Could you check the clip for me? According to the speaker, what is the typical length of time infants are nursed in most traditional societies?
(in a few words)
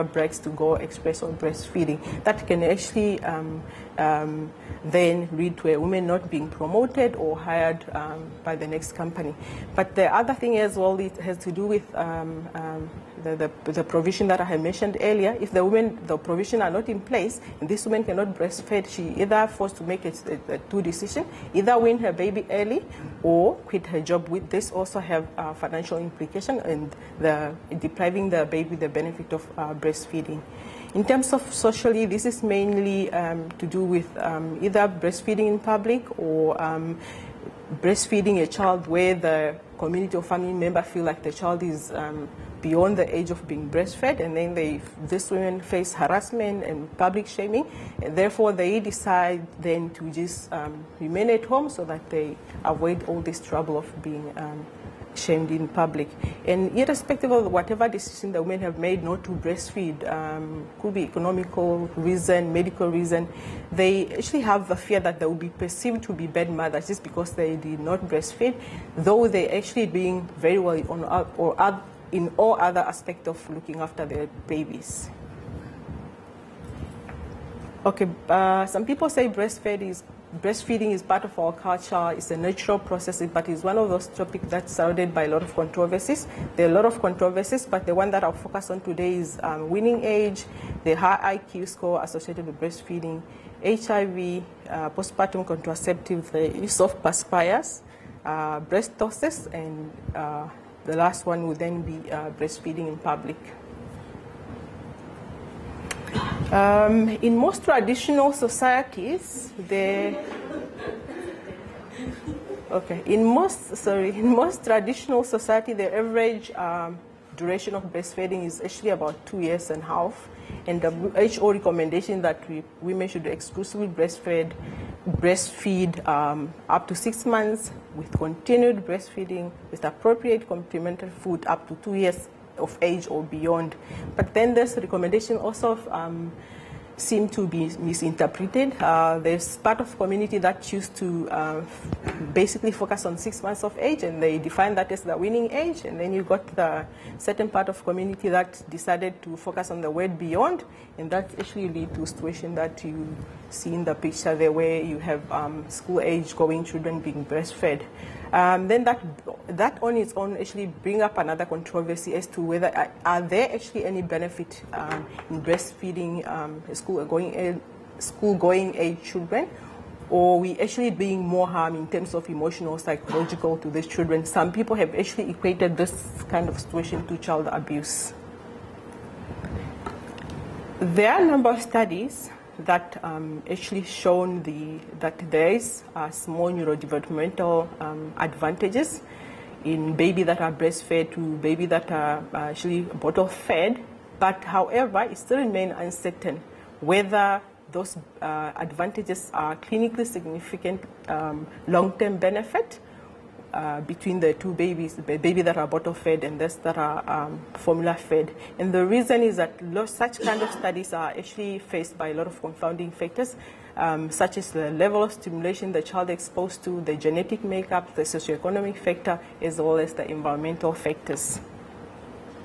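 2.5 years.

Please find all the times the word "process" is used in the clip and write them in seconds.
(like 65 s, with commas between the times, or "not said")
82 s.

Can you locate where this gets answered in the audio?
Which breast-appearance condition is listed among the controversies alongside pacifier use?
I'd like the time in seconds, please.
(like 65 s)
98 s.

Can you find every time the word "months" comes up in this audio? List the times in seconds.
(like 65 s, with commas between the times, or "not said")
127 s, 143 s.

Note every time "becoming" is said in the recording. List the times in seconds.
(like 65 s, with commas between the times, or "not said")
not said.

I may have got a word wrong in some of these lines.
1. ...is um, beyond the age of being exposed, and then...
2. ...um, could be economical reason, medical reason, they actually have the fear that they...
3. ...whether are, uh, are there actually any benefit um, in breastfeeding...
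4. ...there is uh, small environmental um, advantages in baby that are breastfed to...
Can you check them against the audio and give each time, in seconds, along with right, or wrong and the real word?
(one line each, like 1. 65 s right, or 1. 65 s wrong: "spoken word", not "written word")
1. 41 s wrong: "breastfed", not "exposed"
2. 60 s right
3. 162 s right
4. 185 s wrong: "neurodevelopmental", not "environmental".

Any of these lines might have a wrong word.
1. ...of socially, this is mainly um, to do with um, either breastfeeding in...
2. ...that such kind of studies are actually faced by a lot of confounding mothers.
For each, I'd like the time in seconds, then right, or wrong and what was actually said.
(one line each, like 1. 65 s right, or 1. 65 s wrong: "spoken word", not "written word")
1. 31 s right
2. 209 s wrong: "factors", not "mothers".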